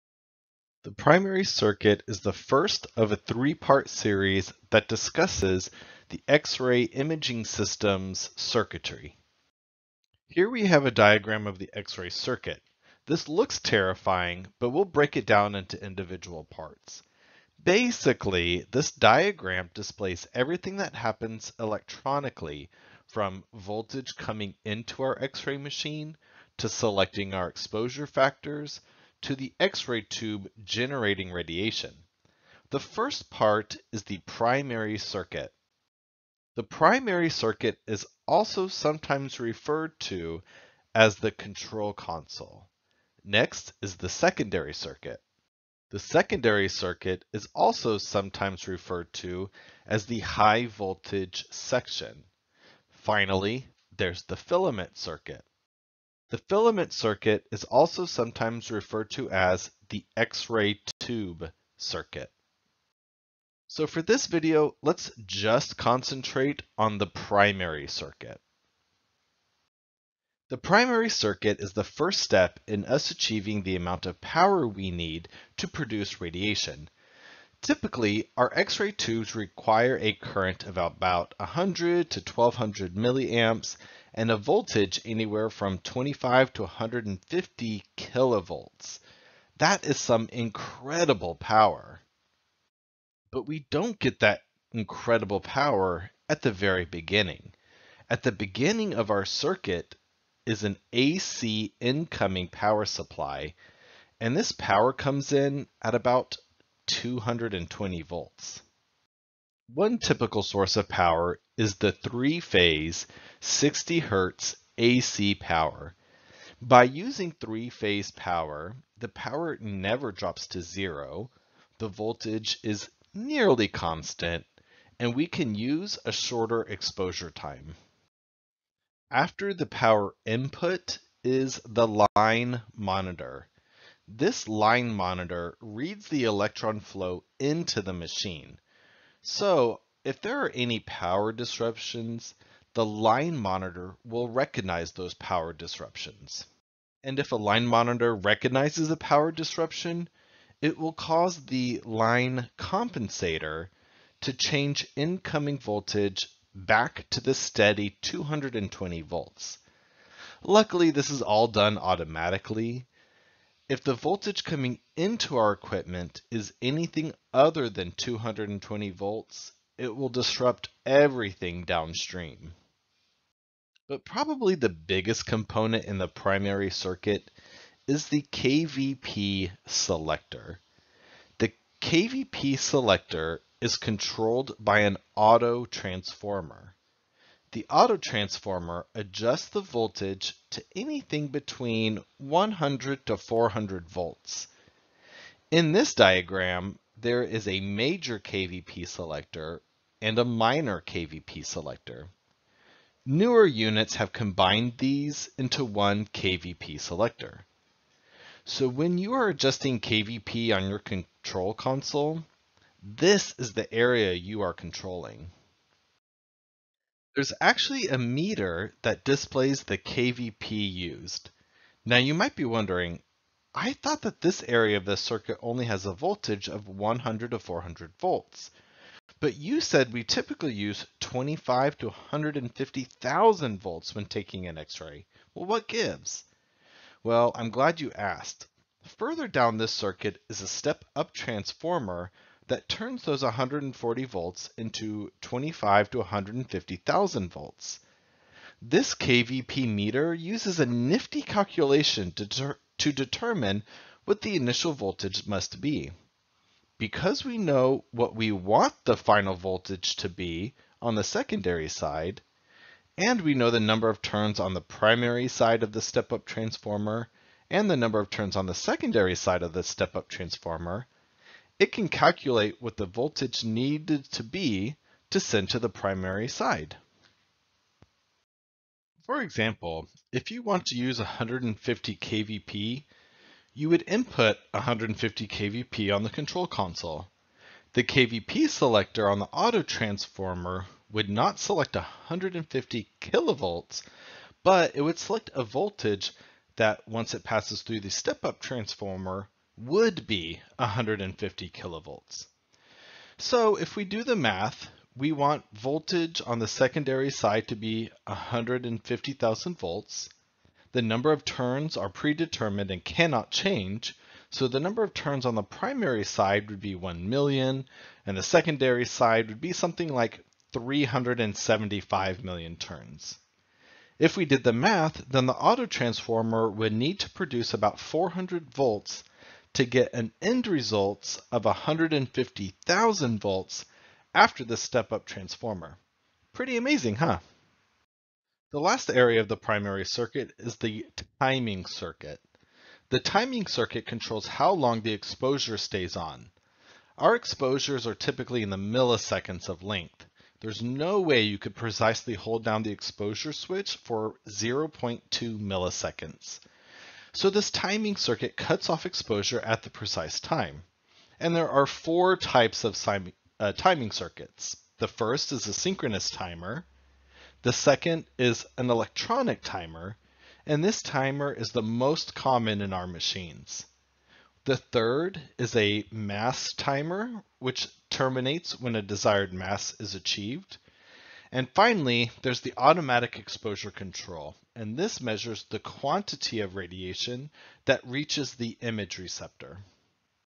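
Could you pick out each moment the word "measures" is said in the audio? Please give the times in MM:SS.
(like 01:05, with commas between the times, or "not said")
06:24.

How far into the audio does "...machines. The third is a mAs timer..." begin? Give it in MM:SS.
06:12.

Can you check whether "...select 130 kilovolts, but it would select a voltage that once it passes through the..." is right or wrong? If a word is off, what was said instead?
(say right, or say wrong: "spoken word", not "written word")
wrong: "150", not "130".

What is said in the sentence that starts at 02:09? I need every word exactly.
After the power input is the line monitor.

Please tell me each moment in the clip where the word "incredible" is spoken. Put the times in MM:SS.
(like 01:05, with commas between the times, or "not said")
01:30, 01:34.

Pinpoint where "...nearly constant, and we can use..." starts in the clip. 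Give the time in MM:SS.
02:03.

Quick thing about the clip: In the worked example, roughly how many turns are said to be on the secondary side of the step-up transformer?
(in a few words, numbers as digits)
375 million.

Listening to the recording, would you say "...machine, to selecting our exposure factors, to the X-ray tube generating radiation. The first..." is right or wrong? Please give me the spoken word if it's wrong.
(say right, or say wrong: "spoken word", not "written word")
right.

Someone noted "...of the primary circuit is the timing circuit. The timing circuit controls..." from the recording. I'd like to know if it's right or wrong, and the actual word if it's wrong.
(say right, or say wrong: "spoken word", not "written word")
right.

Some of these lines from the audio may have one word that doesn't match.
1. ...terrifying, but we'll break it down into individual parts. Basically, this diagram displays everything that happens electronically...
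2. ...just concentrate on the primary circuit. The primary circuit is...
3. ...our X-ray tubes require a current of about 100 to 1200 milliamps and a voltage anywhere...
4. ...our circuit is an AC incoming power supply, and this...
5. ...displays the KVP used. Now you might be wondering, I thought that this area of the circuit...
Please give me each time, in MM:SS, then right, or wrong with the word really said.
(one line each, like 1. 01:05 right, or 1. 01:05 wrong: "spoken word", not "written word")
1. 00:13 right
2. 01:05 right
3. 01:18 right
4. 01:39 right
5. 03:39 right.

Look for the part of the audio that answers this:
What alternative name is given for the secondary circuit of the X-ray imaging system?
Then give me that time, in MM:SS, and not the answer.
00:50.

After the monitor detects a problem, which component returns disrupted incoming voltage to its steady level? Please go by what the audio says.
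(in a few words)
line compensator.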